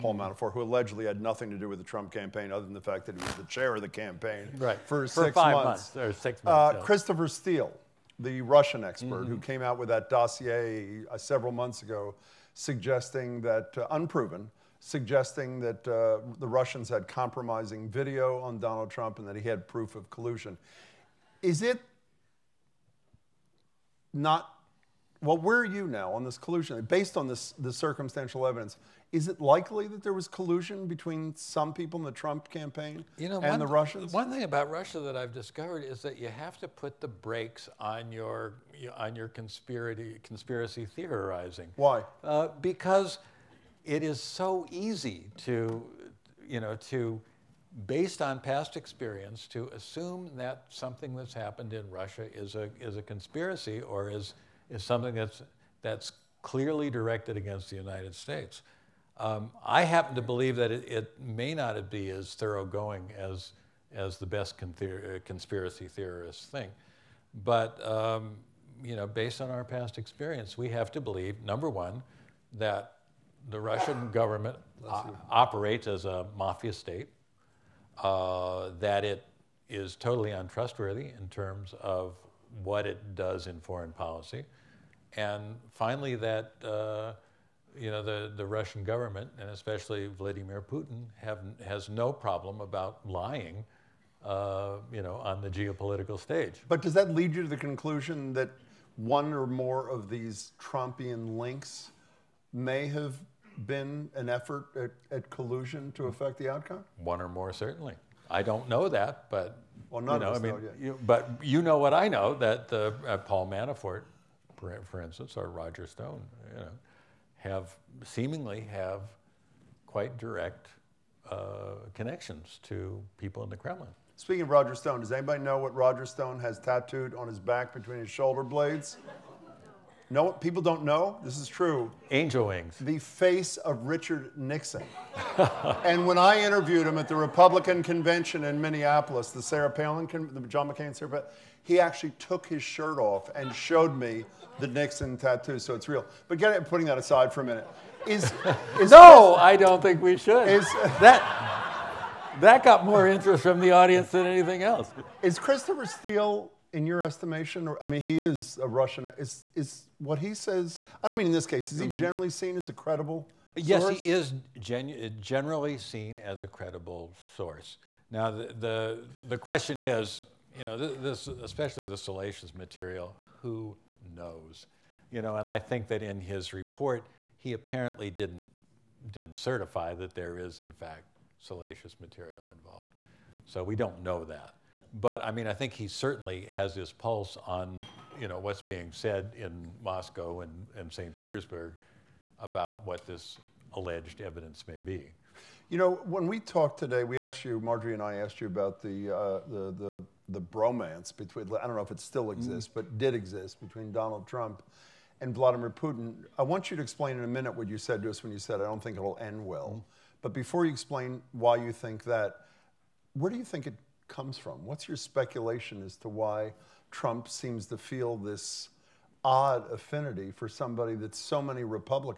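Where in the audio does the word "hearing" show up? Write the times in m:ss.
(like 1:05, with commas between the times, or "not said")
not said.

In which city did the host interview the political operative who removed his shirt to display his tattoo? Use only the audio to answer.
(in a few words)
Minneapolis.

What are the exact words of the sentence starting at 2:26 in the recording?
But get it, putting that aside for a minute.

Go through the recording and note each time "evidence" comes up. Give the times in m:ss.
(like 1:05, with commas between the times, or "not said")
0:28, 3:14.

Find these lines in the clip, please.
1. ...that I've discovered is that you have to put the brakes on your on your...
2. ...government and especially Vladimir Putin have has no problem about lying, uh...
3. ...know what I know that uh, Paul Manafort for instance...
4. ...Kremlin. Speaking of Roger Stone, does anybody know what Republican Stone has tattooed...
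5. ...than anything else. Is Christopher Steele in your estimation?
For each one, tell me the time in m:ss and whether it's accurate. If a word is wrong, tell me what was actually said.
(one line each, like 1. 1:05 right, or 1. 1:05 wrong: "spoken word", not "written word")
1. 0:35 right
2. 1:28 right
3. 1:51 right
4. 2:03 wrong: "Roger", not "Republican"
5. 2:34 right.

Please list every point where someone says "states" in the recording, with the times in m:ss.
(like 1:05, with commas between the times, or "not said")
0:58, 1:16.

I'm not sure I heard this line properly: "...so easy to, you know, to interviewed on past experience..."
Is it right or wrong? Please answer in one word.
wrong.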